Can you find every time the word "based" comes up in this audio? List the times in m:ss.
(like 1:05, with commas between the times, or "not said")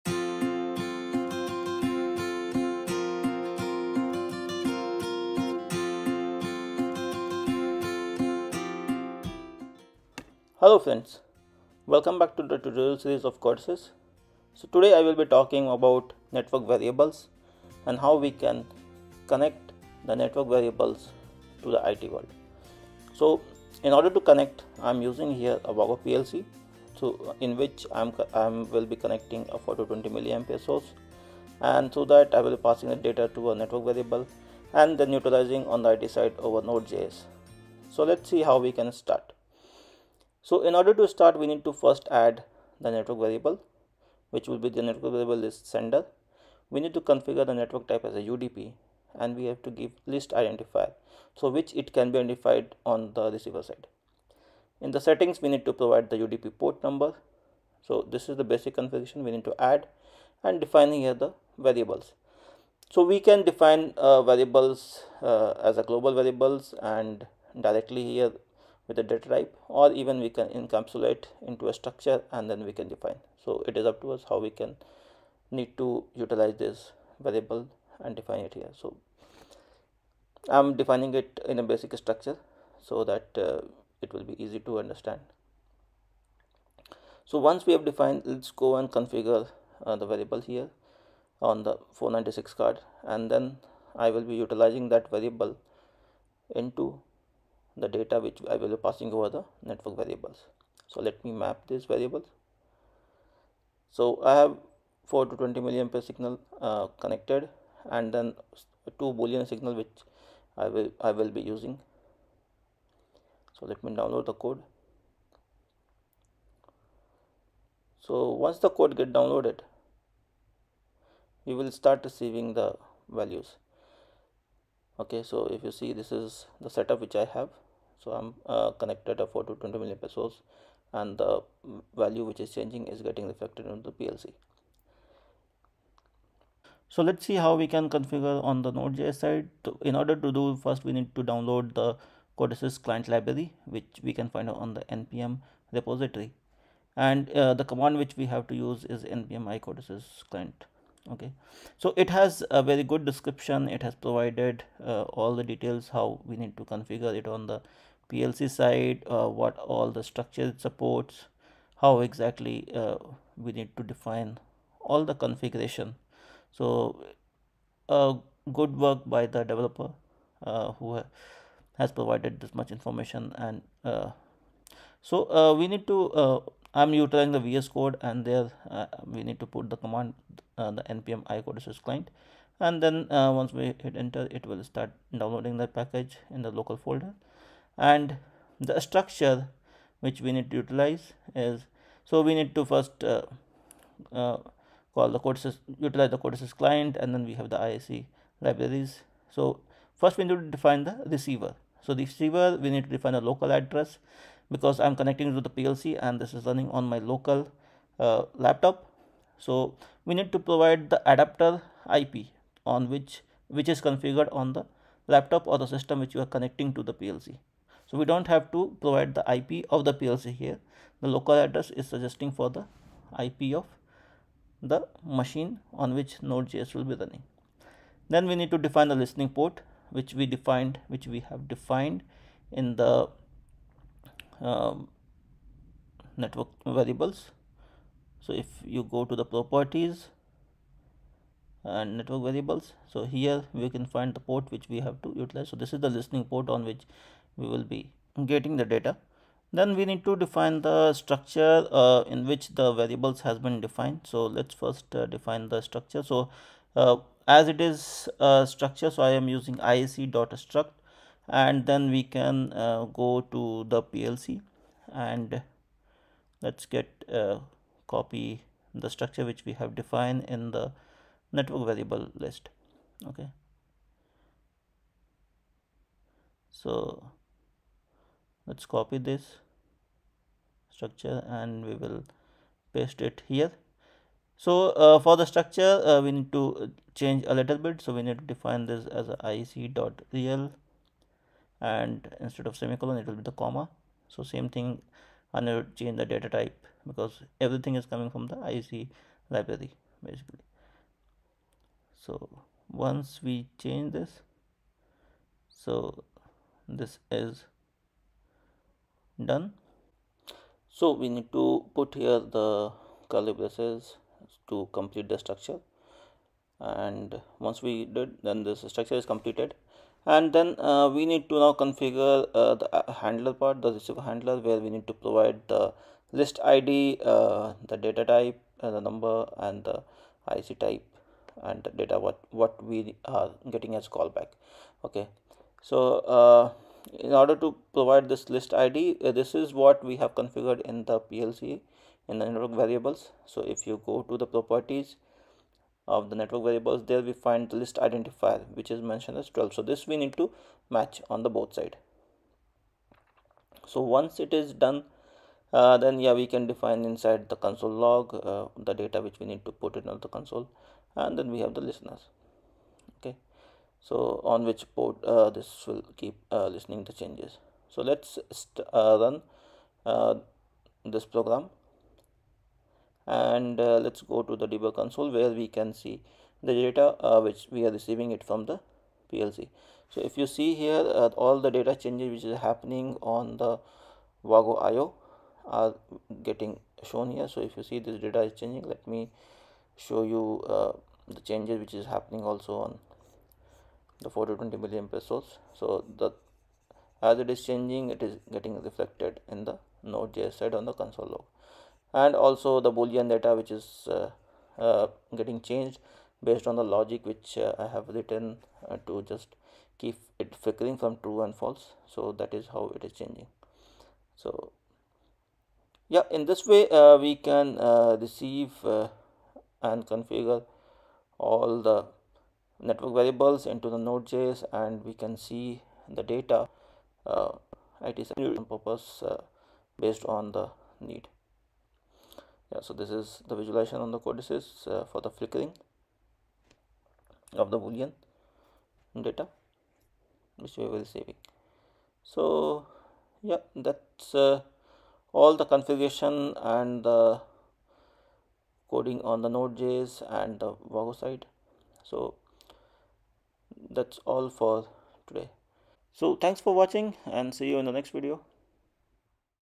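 6:46, 7:09.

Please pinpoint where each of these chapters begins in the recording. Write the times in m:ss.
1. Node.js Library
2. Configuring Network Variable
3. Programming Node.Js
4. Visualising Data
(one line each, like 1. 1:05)
1. 2:18
2. 0:40
3. 2:54
4. 6:10.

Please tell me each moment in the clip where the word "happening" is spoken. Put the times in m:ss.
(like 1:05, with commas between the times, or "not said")
6:22, 6:31.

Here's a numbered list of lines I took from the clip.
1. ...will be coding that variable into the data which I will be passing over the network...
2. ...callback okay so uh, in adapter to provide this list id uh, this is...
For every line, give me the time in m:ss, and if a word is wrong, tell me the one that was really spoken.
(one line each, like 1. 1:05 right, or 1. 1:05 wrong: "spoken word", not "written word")
1. 1:34 wrong: "utilizing", not "coding"
2. 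5:33 wrong: "order", not "adapter".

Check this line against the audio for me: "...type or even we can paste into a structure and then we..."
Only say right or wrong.
wrong.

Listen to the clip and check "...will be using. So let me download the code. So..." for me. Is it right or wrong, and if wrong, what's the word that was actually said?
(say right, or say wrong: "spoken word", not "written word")
right.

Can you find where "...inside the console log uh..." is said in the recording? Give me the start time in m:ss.
5:56.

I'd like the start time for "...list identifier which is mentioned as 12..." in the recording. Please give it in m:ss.
5:47.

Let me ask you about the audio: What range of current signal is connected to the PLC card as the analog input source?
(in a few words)
4 to 20 milliamperes.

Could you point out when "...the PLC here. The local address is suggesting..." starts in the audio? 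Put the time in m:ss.
3:39.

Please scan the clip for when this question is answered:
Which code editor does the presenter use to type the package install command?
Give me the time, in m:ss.
2:57.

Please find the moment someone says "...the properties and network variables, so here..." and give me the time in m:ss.
3:59.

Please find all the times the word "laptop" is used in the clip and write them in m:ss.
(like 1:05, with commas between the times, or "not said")
3:28, 3:35.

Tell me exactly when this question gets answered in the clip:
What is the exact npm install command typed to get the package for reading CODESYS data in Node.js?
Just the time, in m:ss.
2:29.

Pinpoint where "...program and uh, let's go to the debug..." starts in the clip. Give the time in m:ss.
6:11.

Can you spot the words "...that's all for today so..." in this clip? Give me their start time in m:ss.
7:33.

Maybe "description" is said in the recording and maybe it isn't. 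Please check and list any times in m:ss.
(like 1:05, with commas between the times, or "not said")
2:33.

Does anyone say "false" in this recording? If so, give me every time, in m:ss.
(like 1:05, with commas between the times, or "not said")
6:51.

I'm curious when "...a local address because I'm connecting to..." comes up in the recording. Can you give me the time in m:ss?
3:23.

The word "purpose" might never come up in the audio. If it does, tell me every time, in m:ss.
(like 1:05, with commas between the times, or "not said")
7:08.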